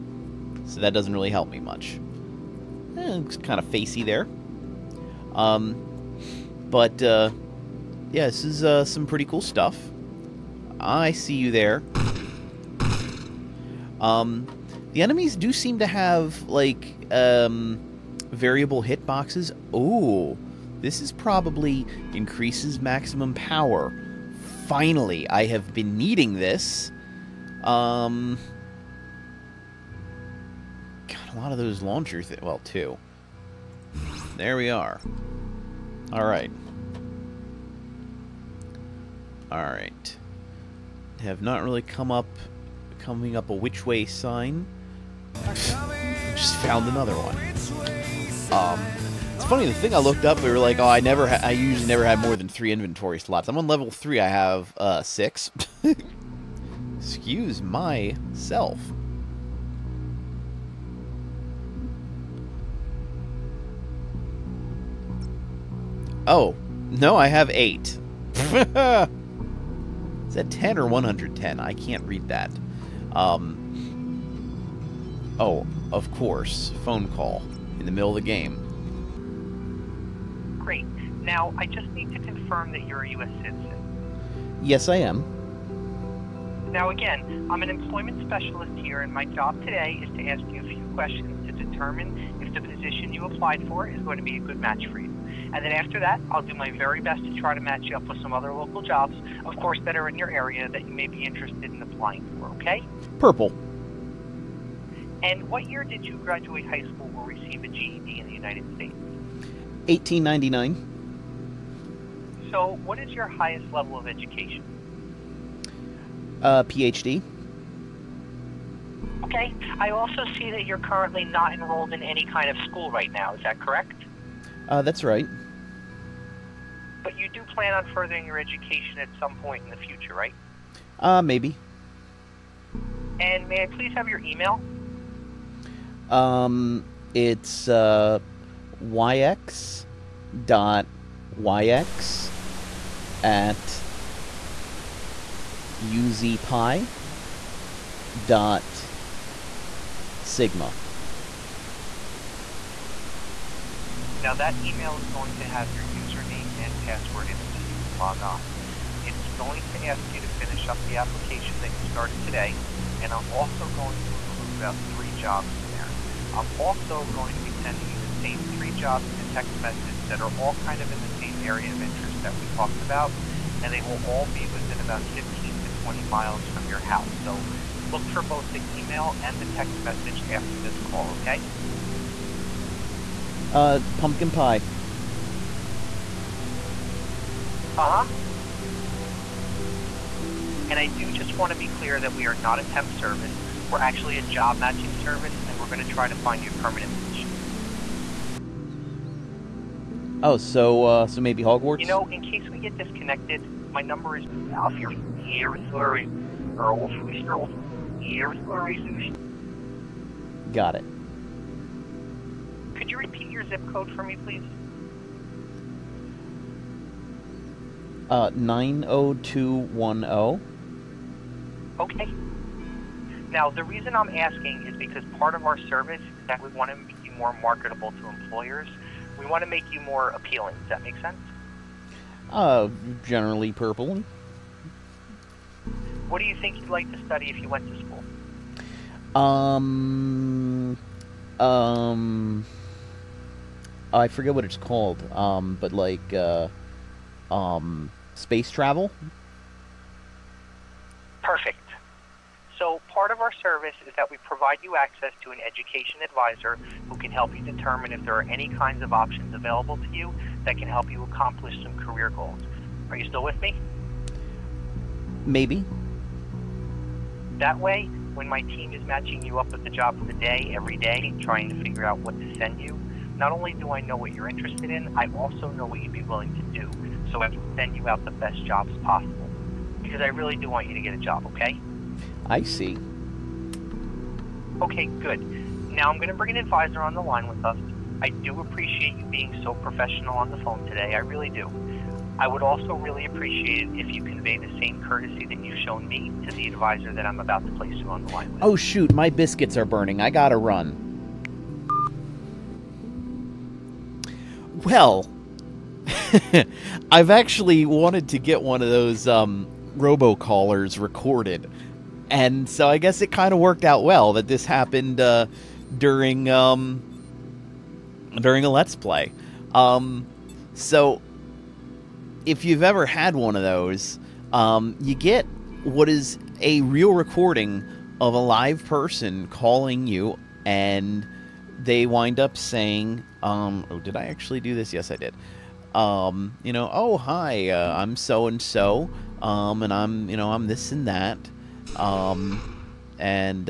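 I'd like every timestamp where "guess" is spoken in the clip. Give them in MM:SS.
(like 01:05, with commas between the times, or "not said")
05:12.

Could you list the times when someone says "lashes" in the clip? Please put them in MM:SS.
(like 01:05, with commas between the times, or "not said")
not said.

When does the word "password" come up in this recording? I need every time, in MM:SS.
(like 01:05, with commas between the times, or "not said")
02:36.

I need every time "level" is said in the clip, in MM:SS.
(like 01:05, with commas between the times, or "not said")
00:53, 01:53.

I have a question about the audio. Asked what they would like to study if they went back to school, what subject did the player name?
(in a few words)
space travel.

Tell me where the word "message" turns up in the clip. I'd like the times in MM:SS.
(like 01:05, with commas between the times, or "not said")
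02:49, 02:59.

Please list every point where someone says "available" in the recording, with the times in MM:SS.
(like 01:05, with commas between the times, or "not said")
04:19.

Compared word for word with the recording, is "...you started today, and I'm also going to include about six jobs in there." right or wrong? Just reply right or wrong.
wrong.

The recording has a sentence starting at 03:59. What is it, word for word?
Um, um, I forget what it's called.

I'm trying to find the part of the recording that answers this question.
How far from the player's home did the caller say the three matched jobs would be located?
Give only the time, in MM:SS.
02:55.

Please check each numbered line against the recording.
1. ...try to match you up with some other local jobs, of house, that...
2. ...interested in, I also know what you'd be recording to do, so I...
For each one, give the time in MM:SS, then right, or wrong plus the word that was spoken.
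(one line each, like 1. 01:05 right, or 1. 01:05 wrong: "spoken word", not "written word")
1. 01:37 wrong: "course", not "house"
2. 04:34 wrong: "willing", not "recording".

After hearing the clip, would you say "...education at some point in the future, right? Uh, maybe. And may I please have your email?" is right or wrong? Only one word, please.
right.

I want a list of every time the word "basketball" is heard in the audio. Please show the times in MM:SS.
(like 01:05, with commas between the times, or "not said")
not said.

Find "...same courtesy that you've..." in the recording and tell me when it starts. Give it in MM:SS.
04:54.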